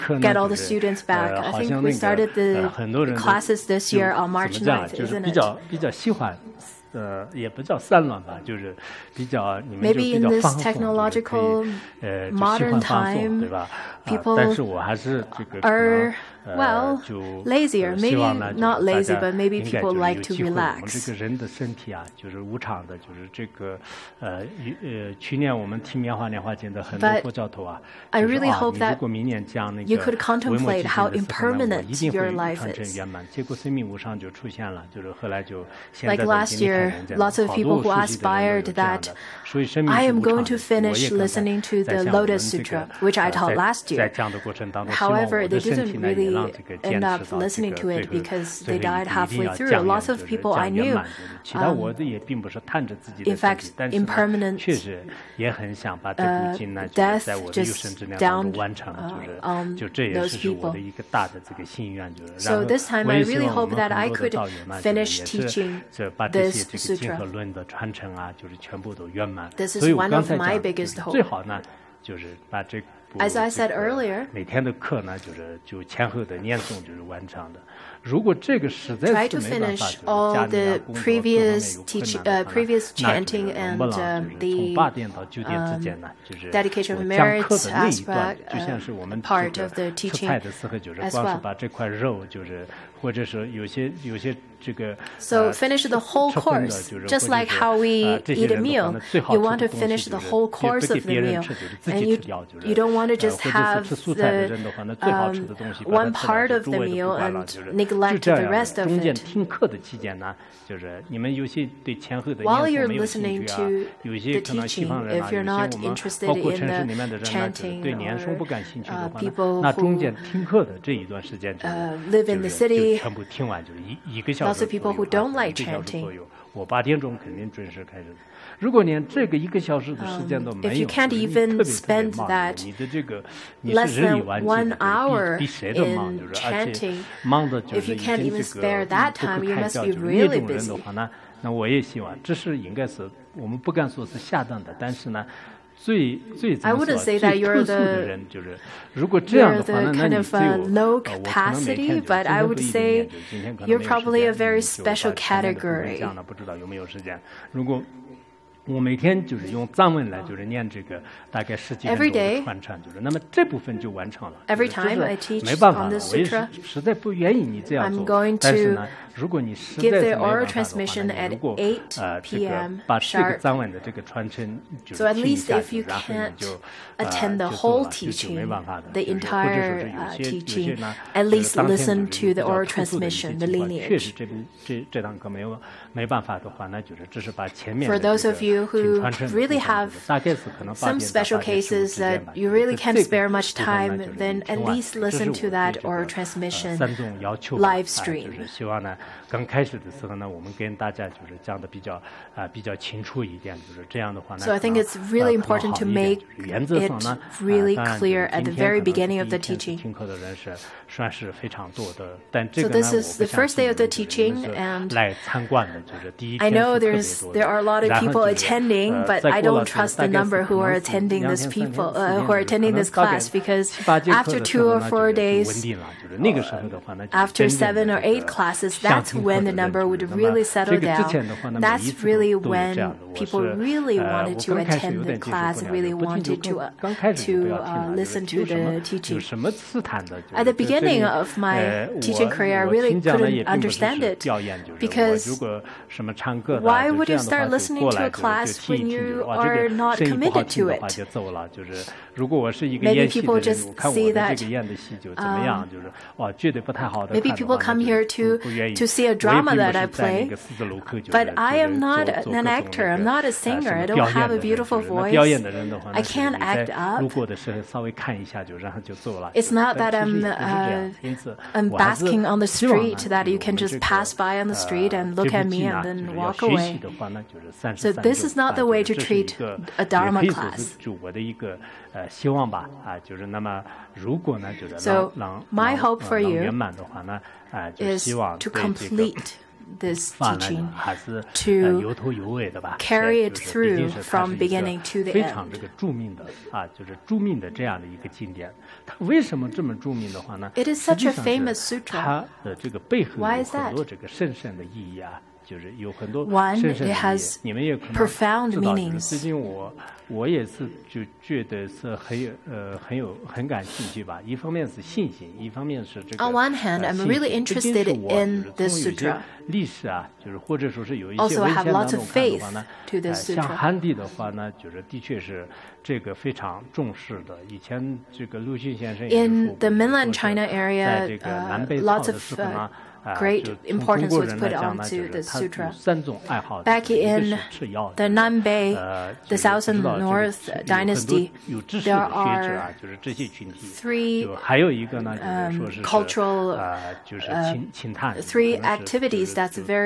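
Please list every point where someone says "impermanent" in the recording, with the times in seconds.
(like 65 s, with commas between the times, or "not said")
31 s, 53 s.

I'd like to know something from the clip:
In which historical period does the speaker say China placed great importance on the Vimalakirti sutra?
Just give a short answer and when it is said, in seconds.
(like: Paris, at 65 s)
South and North dynasty, at 339 s.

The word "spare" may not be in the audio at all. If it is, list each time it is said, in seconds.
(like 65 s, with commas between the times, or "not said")
192 s.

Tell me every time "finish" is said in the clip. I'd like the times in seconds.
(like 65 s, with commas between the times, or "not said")
40 s, 64 s, 74 s, 95 s, 99 s.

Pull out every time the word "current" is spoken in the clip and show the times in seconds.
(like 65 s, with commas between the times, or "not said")
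not said.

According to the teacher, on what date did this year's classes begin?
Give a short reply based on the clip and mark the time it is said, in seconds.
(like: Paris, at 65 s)
March 9th, at 4 s.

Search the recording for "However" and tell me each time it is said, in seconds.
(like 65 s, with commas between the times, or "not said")
44 s.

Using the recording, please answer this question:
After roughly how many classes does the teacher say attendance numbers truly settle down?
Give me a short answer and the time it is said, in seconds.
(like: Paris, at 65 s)
7 or 8, at 227 s.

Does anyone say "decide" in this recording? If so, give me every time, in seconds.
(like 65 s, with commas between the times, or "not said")
not said.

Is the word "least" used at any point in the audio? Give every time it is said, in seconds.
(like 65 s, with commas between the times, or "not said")
175 s, 181 s, 194 s.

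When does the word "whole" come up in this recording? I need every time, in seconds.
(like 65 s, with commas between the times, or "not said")
95 s, 100 s, 177 s.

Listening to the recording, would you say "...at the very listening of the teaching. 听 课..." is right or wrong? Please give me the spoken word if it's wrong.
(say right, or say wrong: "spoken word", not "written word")
wrong: "beginning", not "listening".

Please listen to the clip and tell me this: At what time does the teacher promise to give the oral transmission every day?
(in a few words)
8 p.m.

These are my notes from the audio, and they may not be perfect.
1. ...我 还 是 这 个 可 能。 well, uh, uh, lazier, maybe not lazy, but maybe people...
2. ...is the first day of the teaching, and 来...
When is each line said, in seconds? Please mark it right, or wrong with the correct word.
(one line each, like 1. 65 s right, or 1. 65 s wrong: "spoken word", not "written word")
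1. 14 s right
2. 213 s right.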